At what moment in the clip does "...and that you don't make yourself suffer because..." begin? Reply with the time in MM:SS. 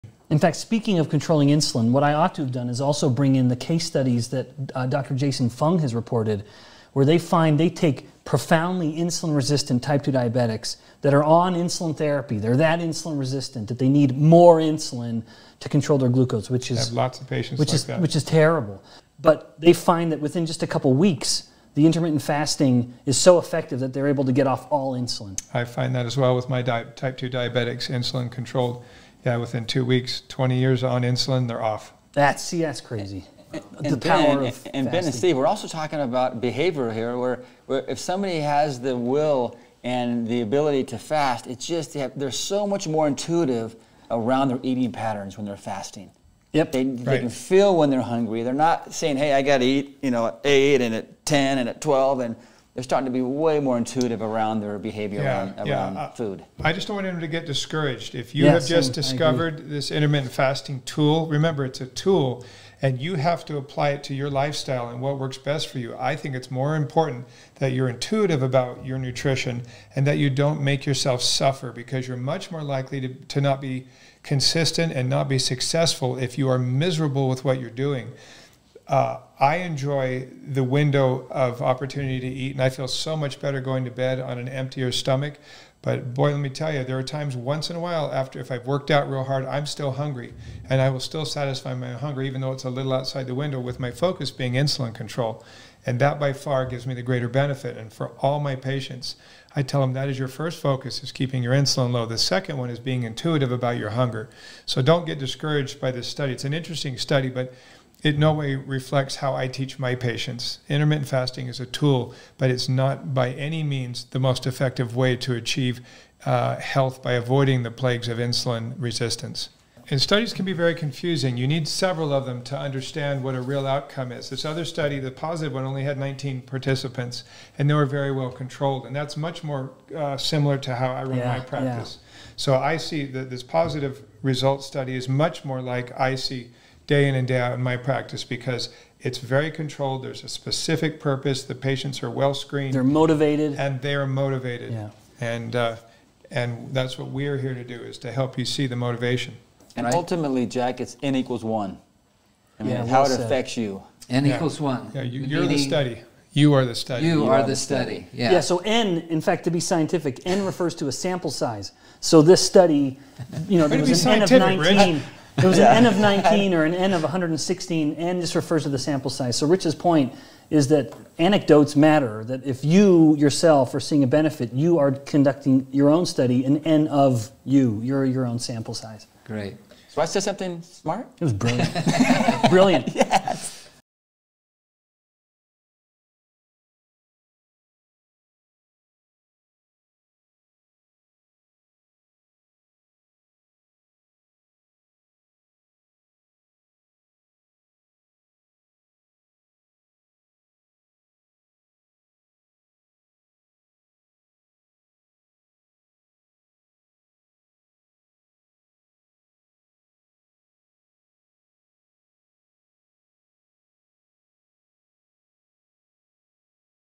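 01:09.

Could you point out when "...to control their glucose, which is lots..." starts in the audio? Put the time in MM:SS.
00:15.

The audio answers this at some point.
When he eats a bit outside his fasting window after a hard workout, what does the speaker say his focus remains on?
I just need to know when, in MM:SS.
01:34.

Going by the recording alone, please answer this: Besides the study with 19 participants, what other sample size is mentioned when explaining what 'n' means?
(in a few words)
116.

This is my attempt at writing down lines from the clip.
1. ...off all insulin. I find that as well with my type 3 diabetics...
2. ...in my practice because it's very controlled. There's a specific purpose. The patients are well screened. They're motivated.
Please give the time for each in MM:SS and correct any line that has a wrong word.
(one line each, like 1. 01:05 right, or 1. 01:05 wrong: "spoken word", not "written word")
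1. 00:24 wrong: "2", not "3"
2. 02:17 right.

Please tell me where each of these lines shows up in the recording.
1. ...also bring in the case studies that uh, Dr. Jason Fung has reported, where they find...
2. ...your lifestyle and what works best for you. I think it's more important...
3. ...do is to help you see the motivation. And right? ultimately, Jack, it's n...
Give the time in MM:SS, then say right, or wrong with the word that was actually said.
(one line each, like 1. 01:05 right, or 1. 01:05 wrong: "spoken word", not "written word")
1. 00:02 right
2. 01:04 right
3. 02:27 right.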